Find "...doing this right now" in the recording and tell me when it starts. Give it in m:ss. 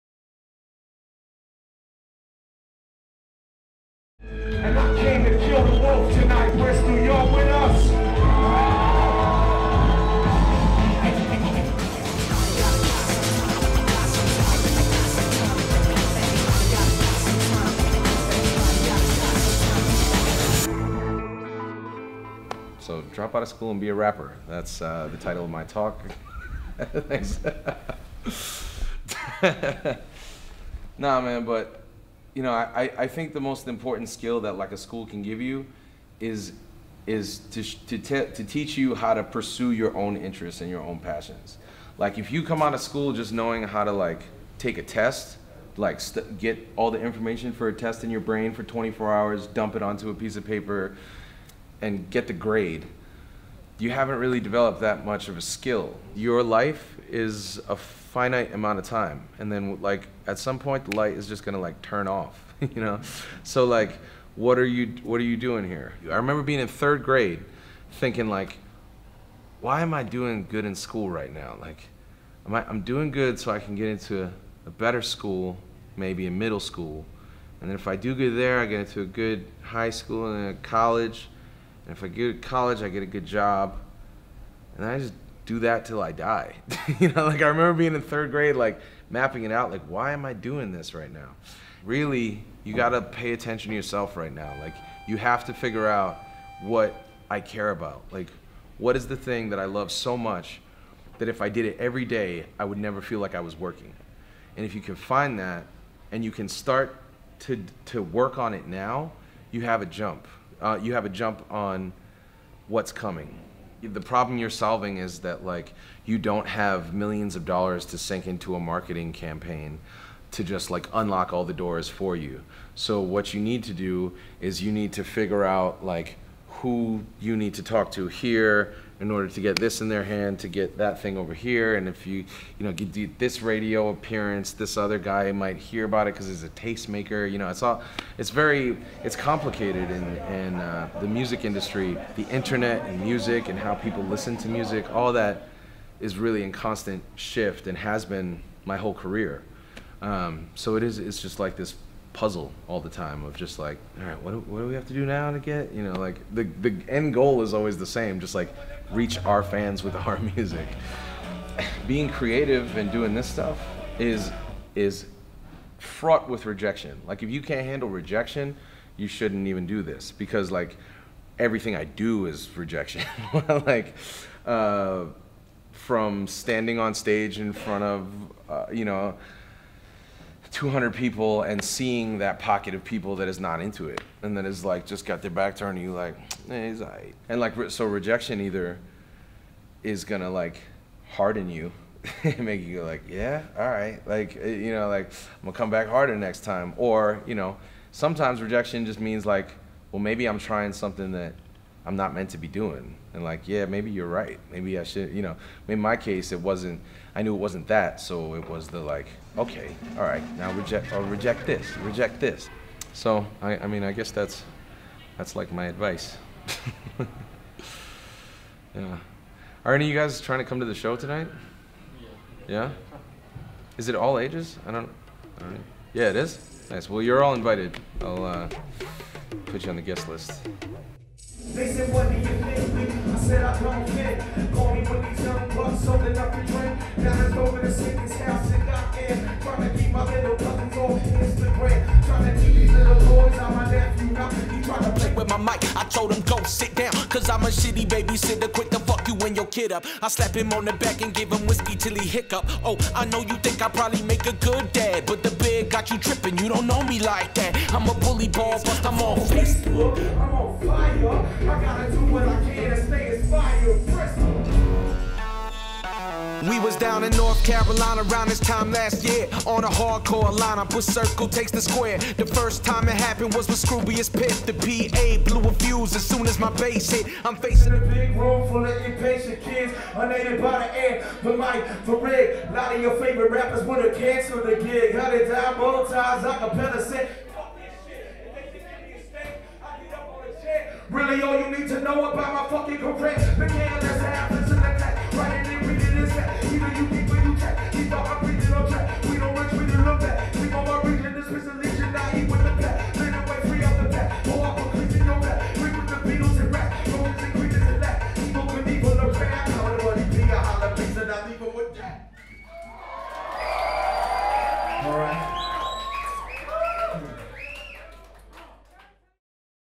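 1:30.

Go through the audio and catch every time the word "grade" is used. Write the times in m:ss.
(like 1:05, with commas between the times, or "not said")
0:52, 1:07, 1:28.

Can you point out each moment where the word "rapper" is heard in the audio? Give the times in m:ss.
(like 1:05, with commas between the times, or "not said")
0:23, 4:43.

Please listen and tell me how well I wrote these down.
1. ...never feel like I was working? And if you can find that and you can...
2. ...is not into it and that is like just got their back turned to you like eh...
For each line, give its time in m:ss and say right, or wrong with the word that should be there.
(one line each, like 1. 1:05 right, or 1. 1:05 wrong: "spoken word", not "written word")
1. 1:42 right
2. 3:03 right.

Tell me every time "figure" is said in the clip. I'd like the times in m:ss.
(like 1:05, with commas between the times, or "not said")
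1:35, 2:05.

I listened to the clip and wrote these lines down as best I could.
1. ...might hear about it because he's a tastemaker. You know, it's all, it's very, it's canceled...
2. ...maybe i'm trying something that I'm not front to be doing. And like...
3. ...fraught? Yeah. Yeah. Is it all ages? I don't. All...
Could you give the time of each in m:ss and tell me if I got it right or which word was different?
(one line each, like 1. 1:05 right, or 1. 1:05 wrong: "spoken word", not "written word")
1. 2:15 wrong: "complicated", not "canceled"
2. 3:19 wrong: "meant", not "front"
3. 3:40 wrong: "tonight", not "fraught".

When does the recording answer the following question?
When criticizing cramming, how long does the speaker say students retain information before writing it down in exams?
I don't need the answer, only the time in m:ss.
0:48.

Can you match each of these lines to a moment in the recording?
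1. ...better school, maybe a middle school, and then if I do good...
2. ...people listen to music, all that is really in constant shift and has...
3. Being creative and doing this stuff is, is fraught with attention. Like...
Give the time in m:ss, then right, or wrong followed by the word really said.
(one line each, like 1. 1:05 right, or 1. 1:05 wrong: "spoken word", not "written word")
1. 1:14 right
2. 2:23 right
3. 2:41 wrong: "rejection", not "attention".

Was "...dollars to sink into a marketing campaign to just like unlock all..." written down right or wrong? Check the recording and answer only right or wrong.
right.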